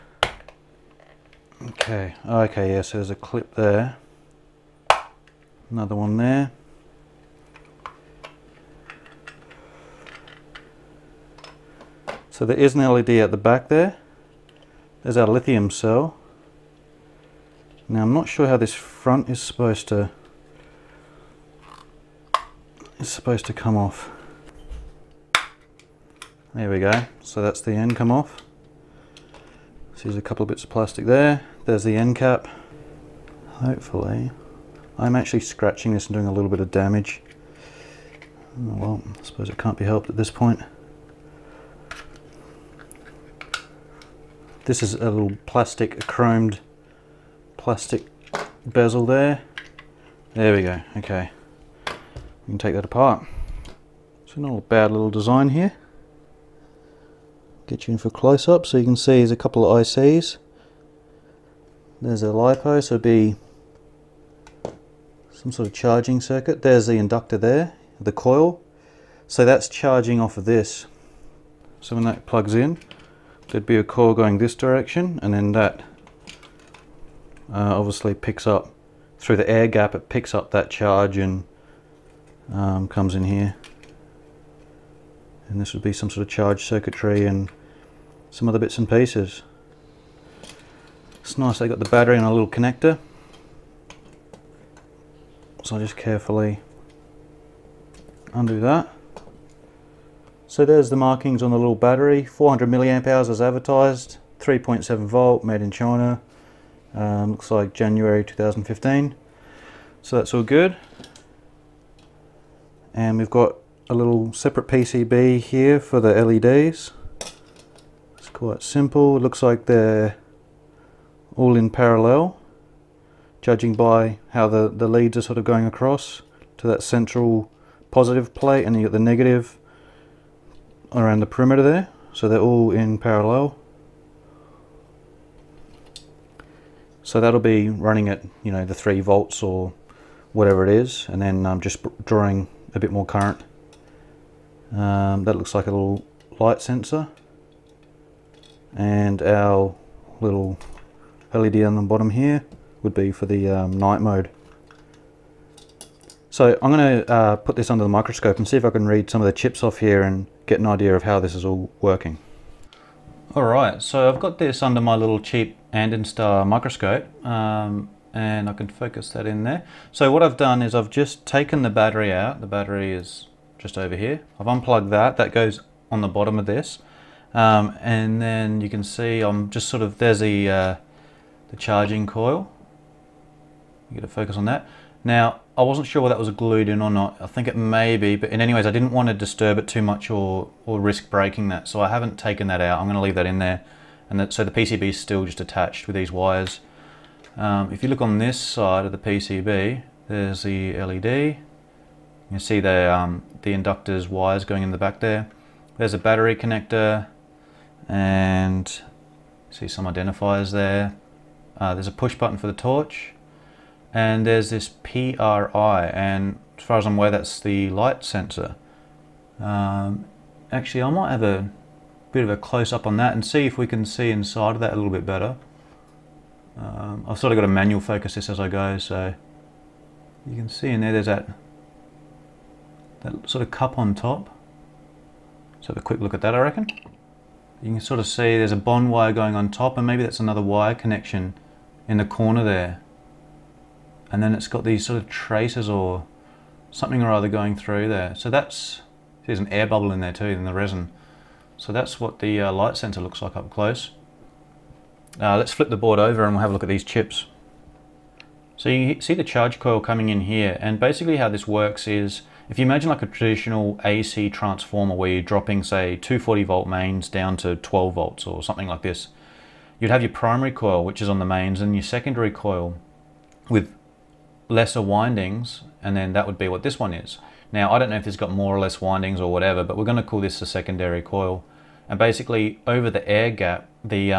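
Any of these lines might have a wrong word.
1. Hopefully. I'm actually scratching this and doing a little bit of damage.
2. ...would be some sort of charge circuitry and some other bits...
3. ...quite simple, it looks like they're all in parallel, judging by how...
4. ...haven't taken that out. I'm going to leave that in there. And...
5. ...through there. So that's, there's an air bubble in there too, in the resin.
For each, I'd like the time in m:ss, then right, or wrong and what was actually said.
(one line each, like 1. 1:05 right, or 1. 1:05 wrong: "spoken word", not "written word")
1. 0:33 right
2. 1:25 right
3. 1:58 right
4. 3:11 right
5. 4:07 right.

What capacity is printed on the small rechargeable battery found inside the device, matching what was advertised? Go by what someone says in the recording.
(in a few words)
400 milliamp hours.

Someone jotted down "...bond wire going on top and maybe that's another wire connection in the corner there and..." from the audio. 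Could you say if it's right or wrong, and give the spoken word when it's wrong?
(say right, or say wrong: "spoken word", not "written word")
right.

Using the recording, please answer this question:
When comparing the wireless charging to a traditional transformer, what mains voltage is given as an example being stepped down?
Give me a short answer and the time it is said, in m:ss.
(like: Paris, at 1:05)
240 volts, at 4:25.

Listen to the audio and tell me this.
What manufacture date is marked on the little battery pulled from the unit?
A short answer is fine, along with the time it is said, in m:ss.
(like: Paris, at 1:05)
January 2015, at 1:47.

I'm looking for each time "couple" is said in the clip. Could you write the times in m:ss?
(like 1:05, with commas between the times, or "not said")
0:30, 0:59.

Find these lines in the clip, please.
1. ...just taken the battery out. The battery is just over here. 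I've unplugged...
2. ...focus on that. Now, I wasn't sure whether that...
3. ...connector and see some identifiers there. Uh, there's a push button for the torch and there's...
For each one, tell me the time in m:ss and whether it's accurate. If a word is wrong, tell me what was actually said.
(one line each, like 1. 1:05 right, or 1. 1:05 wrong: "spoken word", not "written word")
1. 2:50 right
2. 3:04 right
3. 3:26 right.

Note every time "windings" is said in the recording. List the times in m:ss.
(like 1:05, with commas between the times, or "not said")
4:34, 4:38.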